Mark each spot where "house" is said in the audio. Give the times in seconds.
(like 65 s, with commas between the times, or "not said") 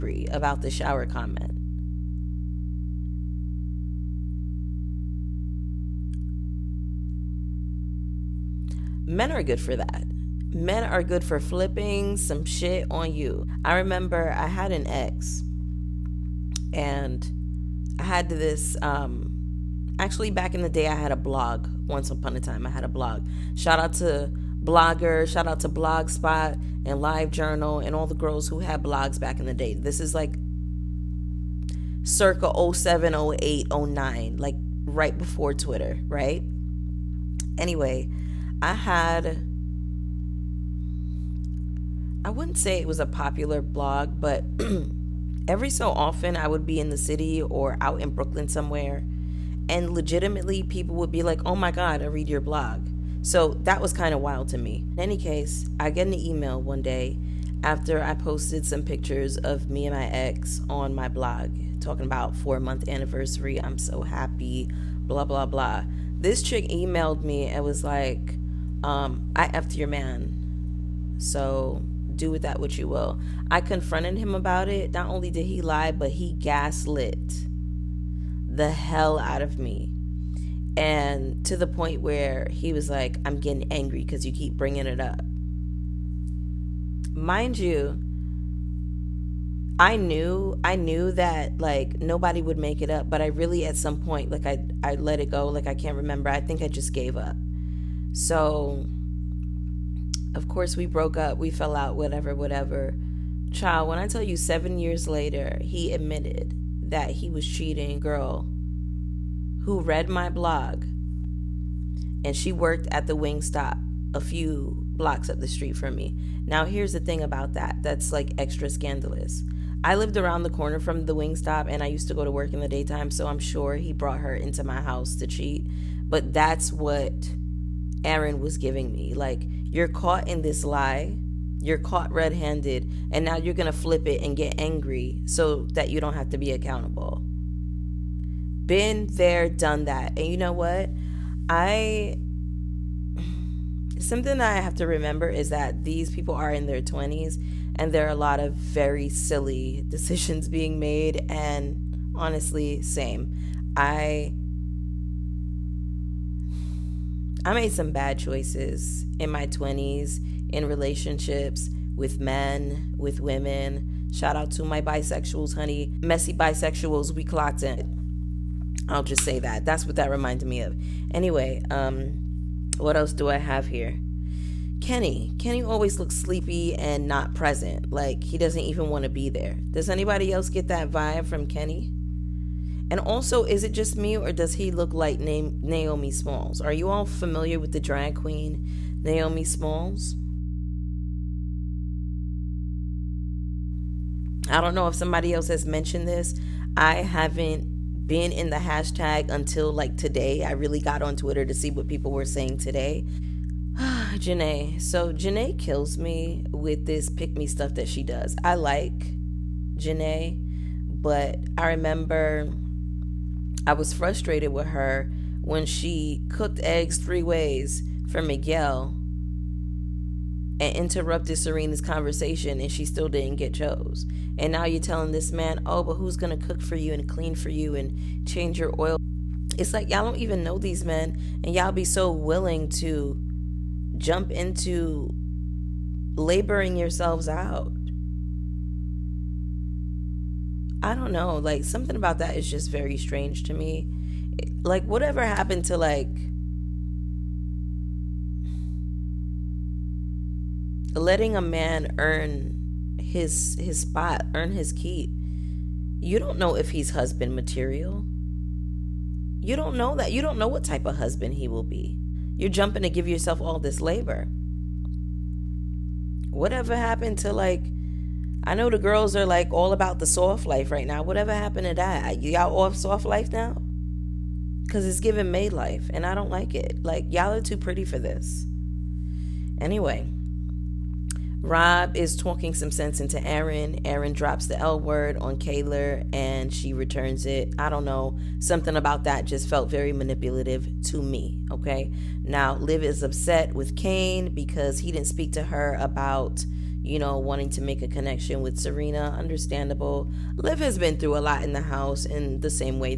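124 s, 301 s.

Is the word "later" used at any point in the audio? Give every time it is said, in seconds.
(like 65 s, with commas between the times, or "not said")
105 s.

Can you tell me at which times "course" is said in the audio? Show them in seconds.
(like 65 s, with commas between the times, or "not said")
100 s.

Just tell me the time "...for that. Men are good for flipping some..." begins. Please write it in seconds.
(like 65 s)
9 s.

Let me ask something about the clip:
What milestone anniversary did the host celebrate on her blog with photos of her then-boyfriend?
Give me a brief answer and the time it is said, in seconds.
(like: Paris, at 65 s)
four month anniversary, at 62 s.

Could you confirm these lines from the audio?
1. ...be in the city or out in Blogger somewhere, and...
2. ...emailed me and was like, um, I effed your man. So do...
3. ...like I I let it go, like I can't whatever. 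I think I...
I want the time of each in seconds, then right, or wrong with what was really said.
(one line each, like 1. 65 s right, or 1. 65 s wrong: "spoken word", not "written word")
1. 46 s wrong: "Brooklyn", not "Blogger"
2. 66 s right
3. 94 s wrong: "remember", not "whatever".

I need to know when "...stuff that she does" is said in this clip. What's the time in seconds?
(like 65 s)
207 s.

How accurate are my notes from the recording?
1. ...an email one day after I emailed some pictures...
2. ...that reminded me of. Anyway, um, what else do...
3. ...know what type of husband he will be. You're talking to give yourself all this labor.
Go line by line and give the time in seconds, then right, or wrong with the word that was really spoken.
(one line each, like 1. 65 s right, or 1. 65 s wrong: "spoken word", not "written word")
1. 56 s wrong: "posted", not "emailed"
2. 169 s right
3. 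260 s wrong: "jumping", not "talking".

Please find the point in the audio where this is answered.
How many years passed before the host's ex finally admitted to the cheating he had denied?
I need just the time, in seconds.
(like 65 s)
104 s.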